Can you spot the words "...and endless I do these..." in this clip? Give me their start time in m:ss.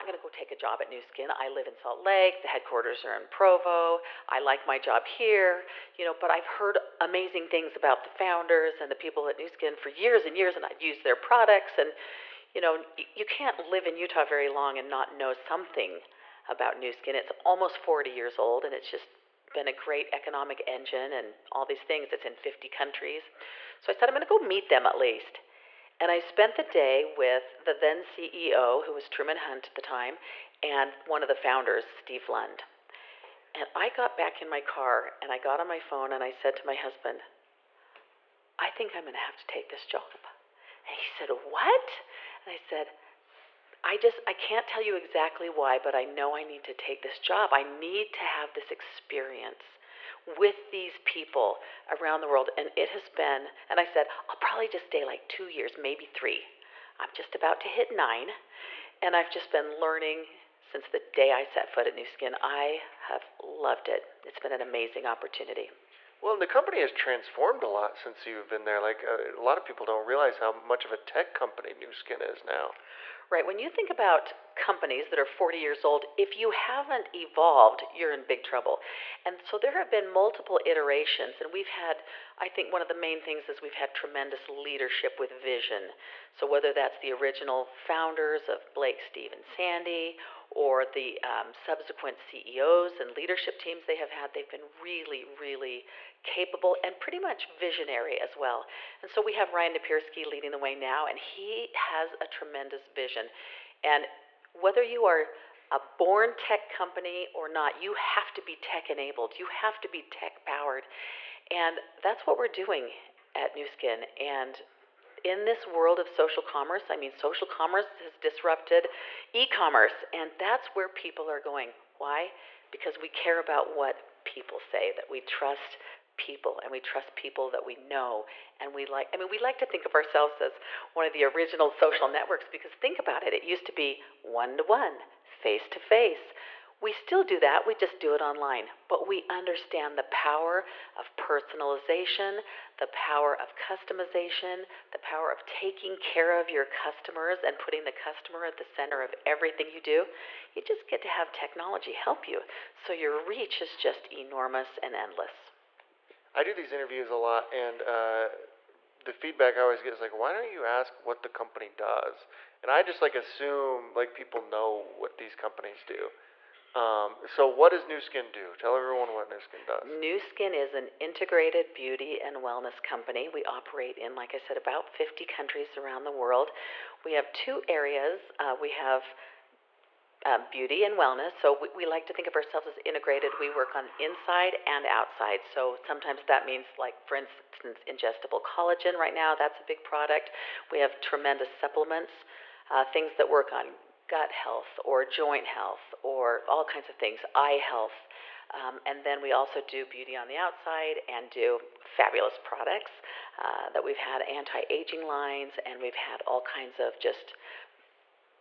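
2:34.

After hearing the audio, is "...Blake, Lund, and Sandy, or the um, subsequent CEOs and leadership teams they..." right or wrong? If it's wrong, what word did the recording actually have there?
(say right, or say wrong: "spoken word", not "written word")
wrong: "Steve", not "Lund".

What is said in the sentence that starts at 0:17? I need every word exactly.
It's almost 40 years old, and it's just been a great economic engine and all these things.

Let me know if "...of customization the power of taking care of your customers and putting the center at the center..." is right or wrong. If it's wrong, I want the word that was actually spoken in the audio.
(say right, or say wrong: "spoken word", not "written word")
wrong: "customer", not "center".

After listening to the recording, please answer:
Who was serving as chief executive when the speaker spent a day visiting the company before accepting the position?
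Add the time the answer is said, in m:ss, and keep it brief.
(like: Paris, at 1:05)
Truman Hunt, at 0:29.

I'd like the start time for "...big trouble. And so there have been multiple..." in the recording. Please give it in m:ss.
1:18.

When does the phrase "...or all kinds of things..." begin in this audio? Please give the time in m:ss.
3:16.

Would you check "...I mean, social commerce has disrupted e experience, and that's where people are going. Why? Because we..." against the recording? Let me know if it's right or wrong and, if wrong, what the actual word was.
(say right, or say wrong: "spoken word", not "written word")
wrong: "commerce", not "experience".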